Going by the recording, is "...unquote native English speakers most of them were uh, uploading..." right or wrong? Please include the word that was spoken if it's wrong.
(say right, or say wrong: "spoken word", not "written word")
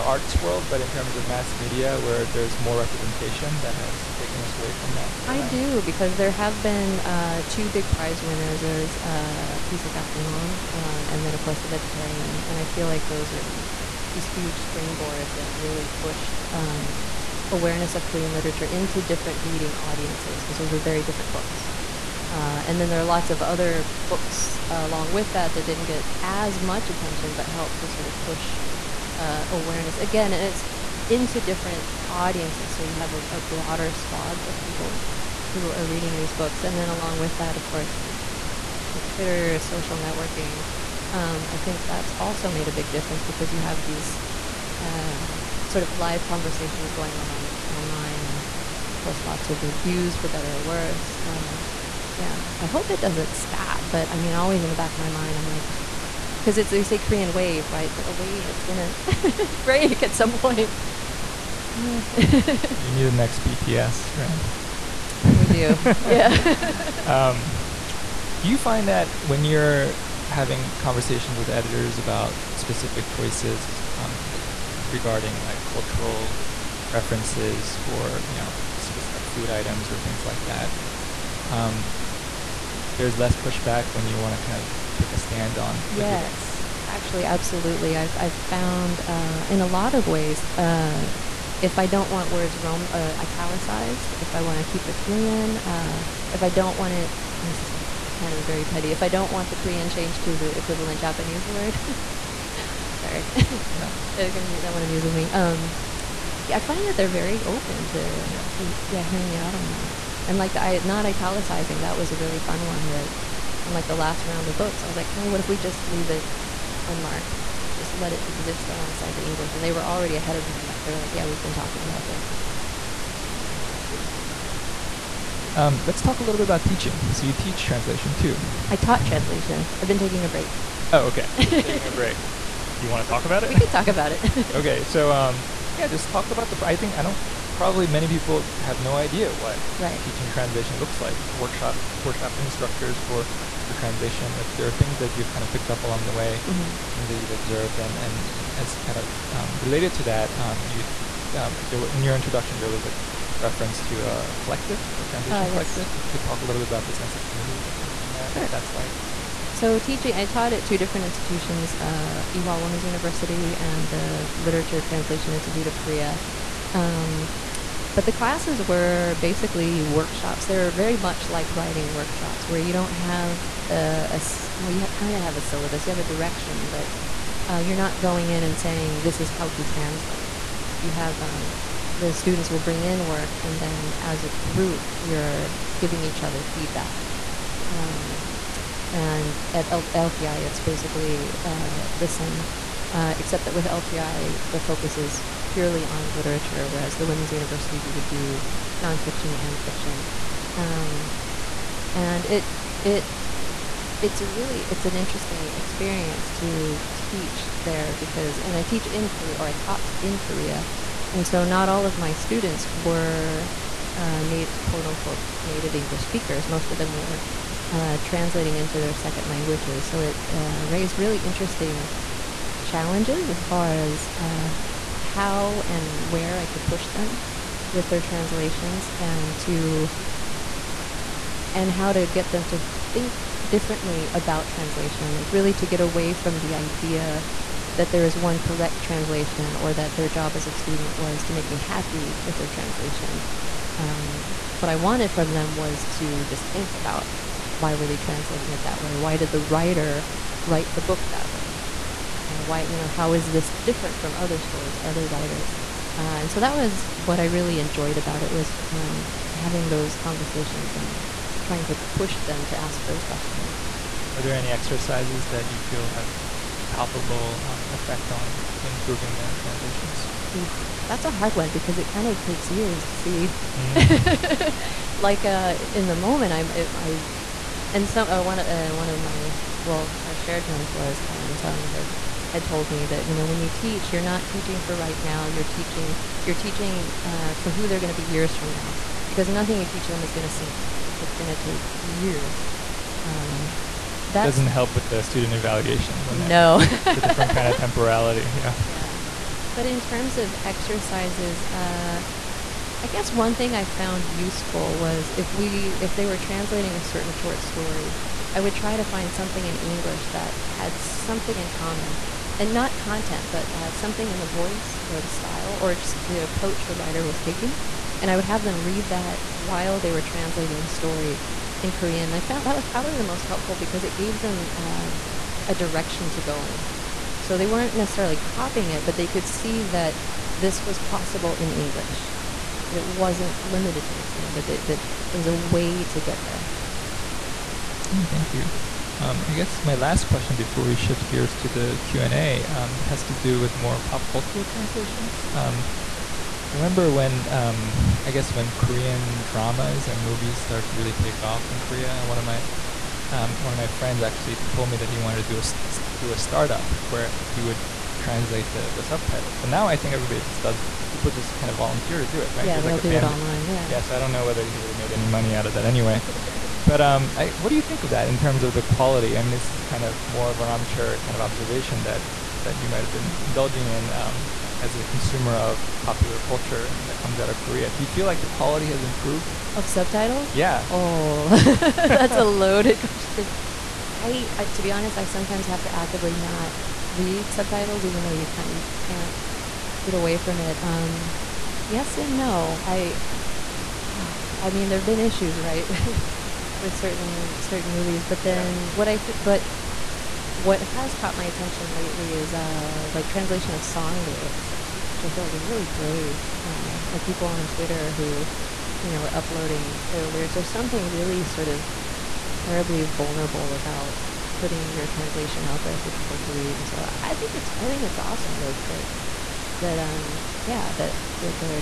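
wrong: "translating", not "uploading".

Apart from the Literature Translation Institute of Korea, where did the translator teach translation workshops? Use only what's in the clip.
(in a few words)
Ewha Women's University.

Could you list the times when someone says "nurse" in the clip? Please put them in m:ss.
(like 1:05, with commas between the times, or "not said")
not said.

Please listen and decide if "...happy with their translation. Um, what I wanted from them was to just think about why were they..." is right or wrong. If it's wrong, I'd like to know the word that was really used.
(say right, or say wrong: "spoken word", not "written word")
right.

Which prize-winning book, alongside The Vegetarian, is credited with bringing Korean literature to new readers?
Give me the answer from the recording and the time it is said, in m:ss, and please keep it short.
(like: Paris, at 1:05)
Please Look After Mom, at 0:09.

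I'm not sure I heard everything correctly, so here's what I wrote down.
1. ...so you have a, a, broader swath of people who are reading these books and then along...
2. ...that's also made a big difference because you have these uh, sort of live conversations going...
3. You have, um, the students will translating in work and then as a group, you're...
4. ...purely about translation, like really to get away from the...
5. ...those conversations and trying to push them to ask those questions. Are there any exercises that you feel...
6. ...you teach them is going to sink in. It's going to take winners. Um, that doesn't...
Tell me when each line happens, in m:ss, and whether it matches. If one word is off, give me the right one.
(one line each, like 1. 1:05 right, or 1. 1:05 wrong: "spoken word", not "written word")
1. 0:32 right
2. 0:41 right
3. 3:00 wrong: "bring", not "translating"
4. 3:53 wrong: "differently", not "purely"
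5. 4:19 right
6. 4:49 wrong: "years", not "winners".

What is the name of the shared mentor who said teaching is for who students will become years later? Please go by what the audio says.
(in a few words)
Hyan Sung.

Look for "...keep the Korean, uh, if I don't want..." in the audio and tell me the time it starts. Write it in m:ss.
1:34.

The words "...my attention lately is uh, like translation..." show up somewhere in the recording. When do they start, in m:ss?
6:41.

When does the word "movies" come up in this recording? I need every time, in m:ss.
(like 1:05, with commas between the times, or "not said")
5:50, 6:37.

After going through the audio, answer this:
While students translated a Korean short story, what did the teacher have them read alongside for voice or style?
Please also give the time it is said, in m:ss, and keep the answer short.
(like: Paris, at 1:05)
something in English, at 5:09.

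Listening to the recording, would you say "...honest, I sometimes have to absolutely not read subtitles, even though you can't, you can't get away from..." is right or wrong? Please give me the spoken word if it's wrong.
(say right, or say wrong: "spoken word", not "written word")
wrong: "actively", not "absolutely".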